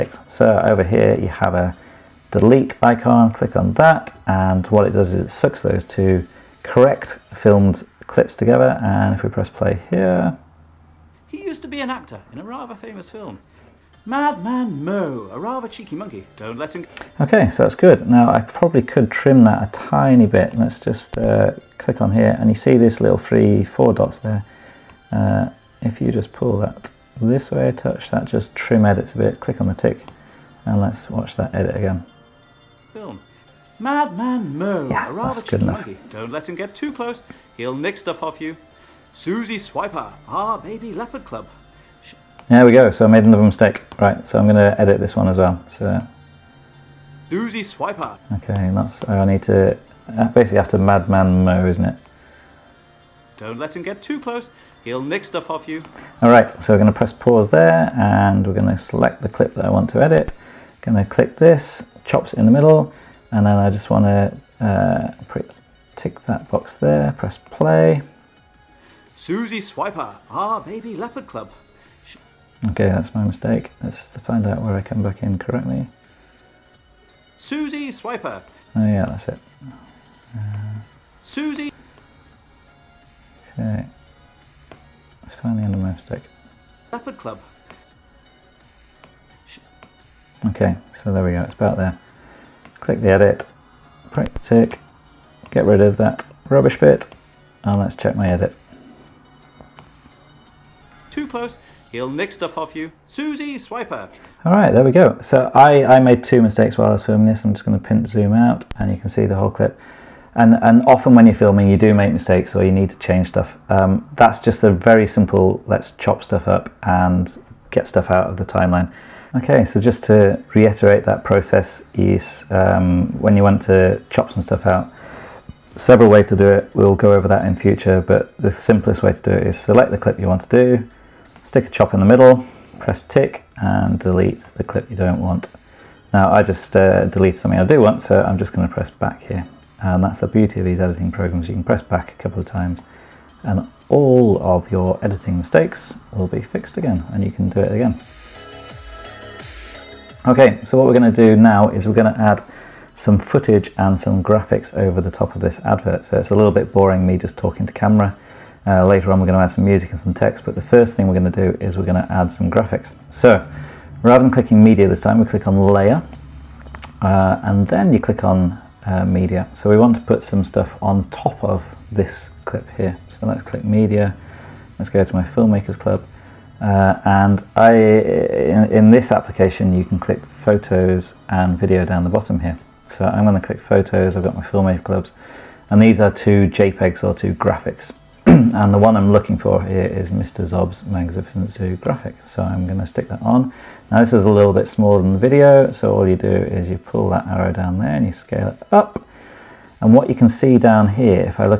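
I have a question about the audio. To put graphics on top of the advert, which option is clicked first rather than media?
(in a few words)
layer.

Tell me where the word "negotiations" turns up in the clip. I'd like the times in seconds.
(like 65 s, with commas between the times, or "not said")
not said.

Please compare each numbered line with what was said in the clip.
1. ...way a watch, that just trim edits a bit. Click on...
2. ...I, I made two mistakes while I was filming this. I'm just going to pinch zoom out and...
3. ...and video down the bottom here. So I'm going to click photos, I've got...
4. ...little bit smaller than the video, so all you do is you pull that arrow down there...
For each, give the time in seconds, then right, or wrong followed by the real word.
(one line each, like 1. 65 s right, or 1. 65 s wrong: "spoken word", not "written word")
1. 27 s wrong: "touch", not "watch"
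2. 105 s right
3. 181 s right
4. 194 s right.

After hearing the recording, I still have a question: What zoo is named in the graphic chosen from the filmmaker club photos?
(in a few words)
Mr. Zob's Magnificent Zoo.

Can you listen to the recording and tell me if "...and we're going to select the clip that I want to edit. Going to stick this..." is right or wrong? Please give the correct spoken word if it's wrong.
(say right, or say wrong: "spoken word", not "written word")
wrong: "click", not "stick".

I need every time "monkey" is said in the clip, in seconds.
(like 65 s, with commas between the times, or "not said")
15 s, 35 s.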